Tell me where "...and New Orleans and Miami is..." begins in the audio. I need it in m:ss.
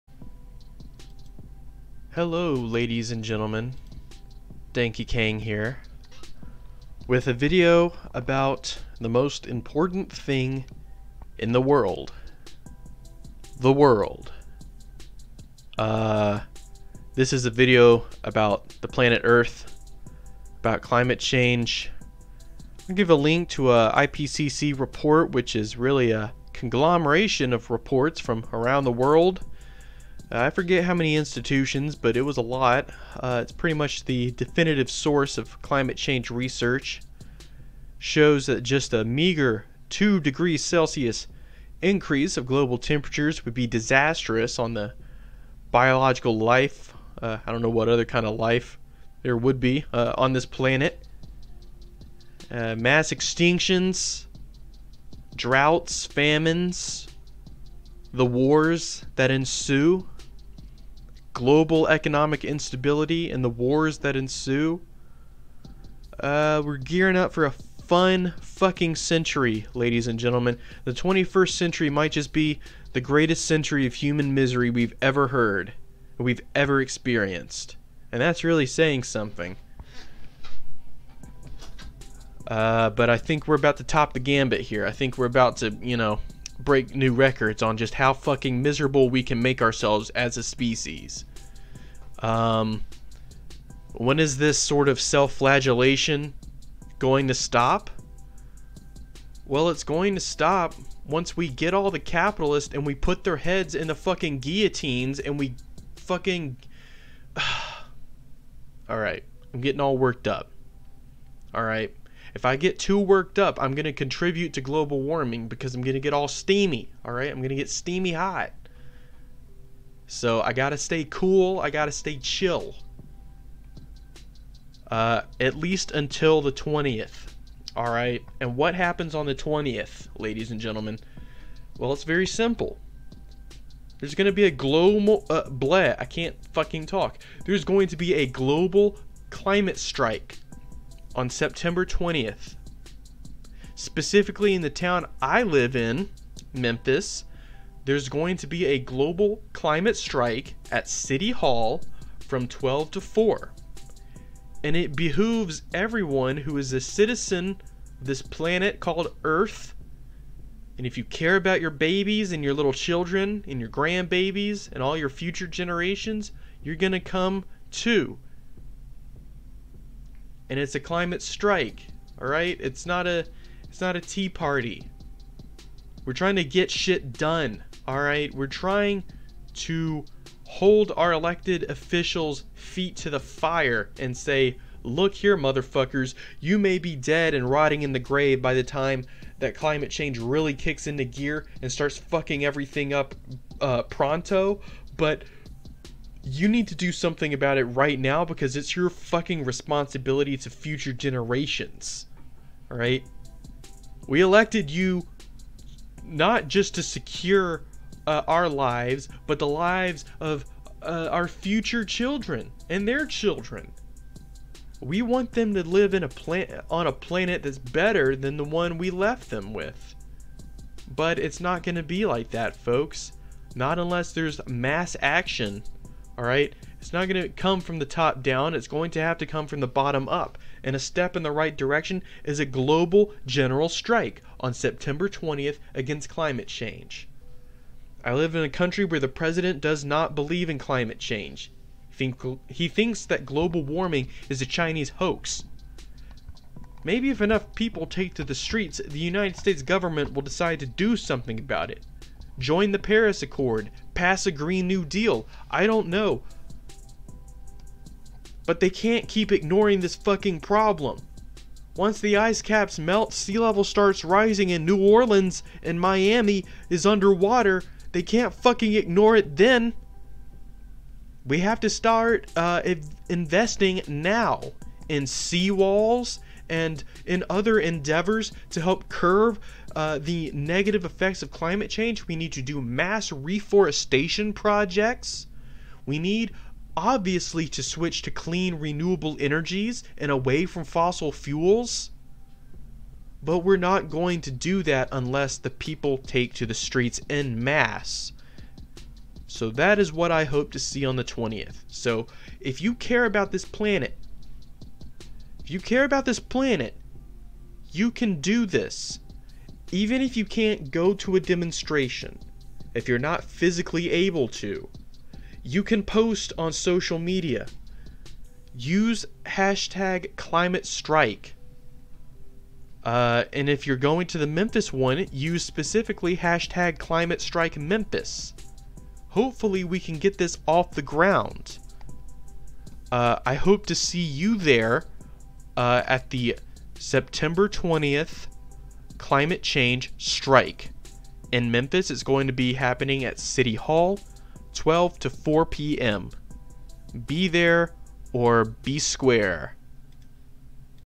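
4:24.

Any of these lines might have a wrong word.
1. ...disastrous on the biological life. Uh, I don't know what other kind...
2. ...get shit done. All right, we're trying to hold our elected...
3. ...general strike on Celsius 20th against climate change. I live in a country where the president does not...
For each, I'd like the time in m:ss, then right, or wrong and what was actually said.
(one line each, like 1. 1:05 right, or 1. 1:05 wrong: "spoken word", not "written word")
1. 0:43 right
2. 2:56 right
3. 3:53 wrong: "September", not "Celsius".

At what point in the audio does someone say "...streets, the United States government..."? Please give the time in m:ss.
4:08.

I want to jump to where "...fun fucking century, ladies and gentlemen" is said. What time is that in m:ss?
1:07.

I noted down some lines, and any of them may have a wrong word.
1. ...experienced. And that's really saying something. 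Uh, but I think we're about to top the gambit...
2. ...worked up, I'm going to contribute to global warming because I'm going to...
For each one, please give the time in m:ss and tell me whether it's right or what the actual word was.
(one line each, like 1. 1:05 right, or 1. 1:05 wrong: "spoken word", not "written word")
1. 1:16 right
2. 1:52 right.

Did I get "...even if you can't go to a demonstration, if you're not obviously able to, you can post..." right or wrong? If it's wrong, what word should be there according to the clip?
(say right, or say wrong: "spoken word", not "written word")
wrong: "physically", not "obviously".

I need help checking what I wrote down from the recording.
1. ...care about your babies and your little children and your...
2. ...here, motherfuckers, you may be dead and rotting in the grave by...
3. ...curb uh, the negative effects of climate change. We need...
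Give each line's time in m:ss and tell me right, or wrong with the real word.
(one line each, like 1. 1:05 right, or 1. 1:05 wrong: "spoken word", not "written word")
1. 2:41 right
2. 3:05 right
3. 4:38 right.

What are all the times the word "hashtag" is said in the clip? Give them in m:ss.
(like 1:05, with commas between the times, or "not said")
5:19, 5:26.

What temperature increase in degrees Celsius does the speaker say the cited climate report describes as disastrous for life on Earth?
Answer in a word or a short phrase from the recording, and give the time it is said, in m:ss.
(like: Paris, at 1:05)
2 degrees, at 0:39.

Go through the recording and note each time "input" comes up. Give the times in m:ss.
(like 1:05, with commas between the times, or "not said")
not said.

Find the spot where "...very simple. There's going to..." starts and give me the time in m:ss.
2:12.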